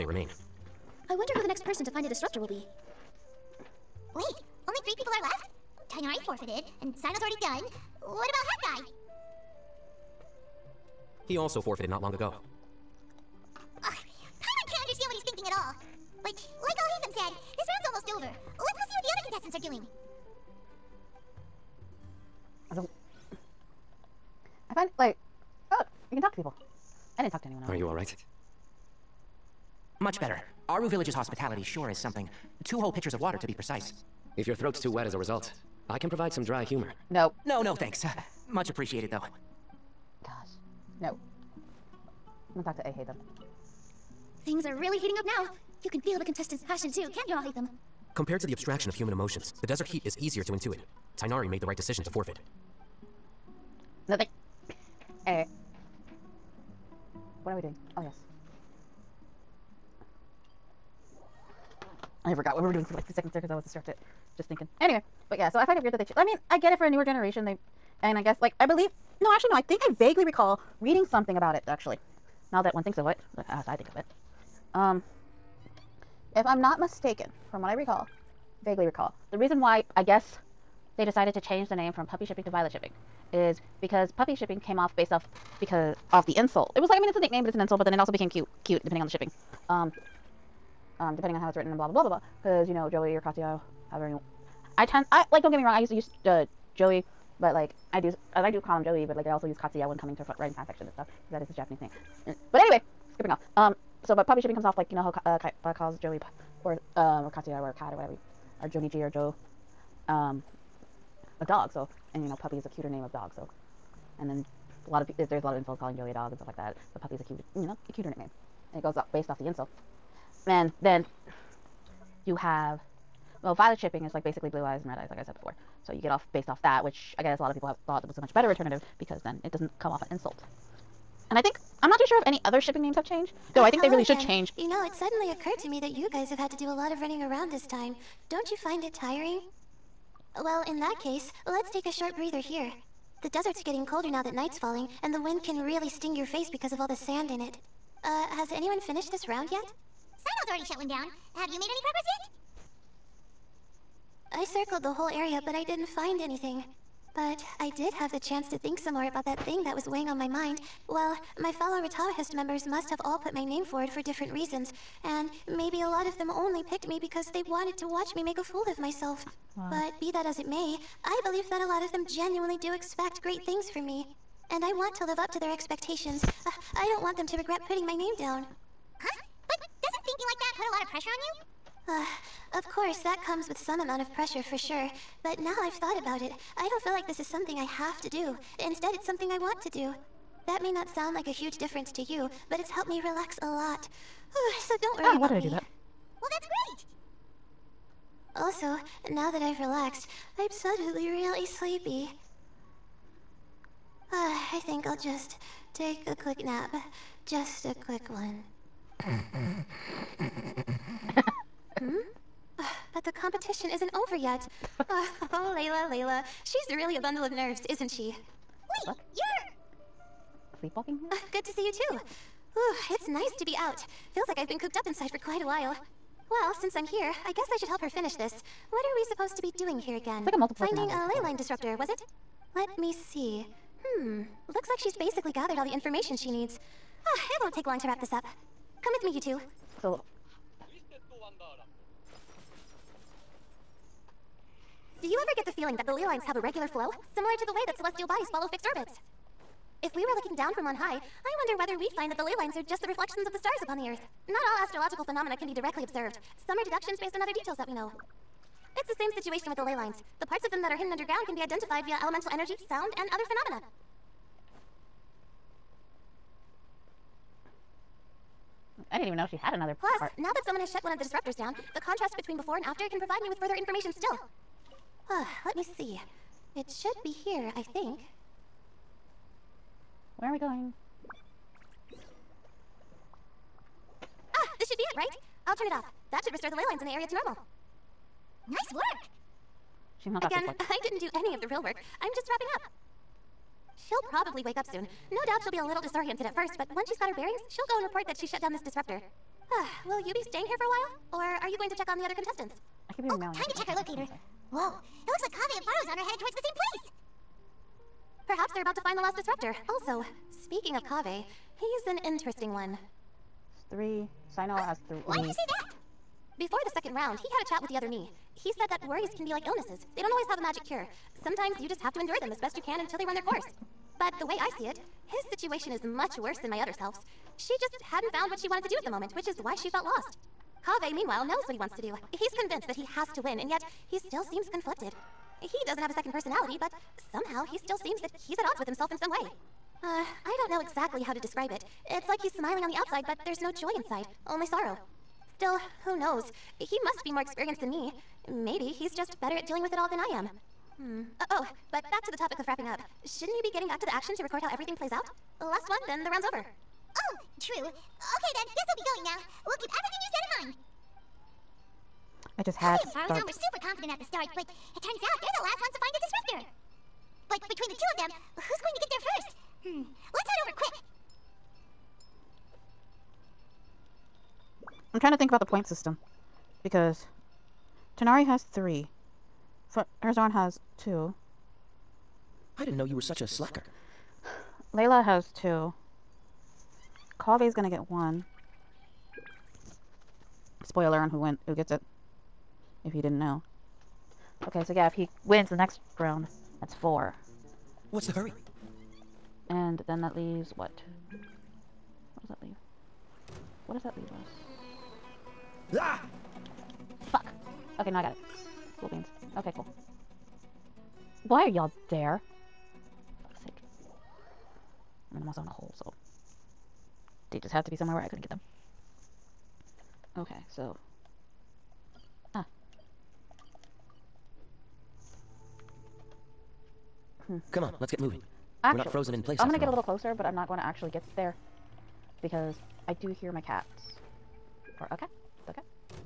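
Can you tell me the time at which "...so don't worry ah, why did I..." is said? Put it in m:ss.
3:14.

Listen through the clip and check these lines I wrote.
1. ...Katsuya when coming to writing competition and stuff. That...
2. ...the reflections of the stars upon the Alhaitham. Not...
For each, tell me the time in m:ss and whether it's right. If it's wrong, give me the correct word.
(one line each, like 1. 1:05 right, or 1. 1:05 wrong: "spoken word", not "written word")
1. 1:39 wrong: "fanfiction", not "competition"
2. 4:12 wrong: "Earth", not "Alhaitham".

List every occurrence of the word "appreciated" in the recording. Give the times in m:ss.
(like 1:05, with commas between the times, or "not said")
0:38.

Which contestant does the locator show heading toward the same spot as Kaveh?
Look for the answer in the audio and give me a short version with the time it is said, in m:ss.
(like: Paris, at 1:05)
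Faruzan, at 5:05.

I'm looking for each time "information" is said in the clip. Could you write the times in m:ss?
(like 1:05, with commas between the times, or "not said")
3:55, 4:33.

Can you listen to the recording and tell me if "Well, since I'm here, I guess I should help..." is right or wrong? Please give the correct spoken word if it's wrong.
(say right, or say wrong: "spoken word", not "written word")
right.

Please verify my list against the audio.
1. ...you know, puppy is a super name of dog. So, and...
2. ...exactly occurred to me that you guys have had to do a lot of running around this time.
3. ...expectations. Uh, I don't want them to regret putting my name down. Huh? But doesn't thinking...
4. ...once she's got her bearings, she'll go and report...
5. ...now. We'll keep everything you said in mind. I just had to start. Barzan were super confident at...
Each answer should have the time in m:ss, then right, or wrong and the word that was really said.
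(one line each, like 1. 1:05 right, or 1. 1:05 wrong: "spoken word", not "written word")
1. 1:52 wrong: "cuter", not "super"
2. 2:14 wrong: "suddenly", not "exactly"
3. 2:55 right
4. 4:56 right
5. 5:59 right.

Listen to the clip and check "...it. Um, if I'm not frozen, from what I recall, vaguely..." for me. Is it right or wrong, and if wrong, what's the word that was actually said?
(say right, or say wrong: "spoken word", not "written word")
wrong: "mistaken", not "frozen".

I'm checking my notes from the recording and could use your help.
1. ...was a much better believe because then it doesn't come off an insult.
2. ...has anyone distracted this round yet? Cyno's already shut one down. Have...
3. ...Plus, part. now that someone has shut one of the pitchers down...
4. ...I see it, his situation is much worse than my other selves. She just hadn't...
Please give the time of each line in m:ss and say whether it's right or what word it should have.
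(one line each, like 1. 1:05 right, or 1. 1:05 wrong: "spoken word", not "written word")
1. 2:08 wrong: "alternative", not "believe"
2. 2:28 wrong: "finished", not "distracted"
3. 4:29 wrong: "disruptors", not "pitchers"
4. 5:24 right.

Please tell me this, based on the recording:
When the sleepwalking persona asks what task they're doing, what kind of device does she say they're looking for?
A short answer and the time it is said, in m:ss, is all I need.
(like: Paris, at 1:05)
ley line disruptor, at 3:51.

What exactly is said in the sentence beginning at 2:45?
And maybe a lot of them only picked me because they wanted to watch me make a fool of myself.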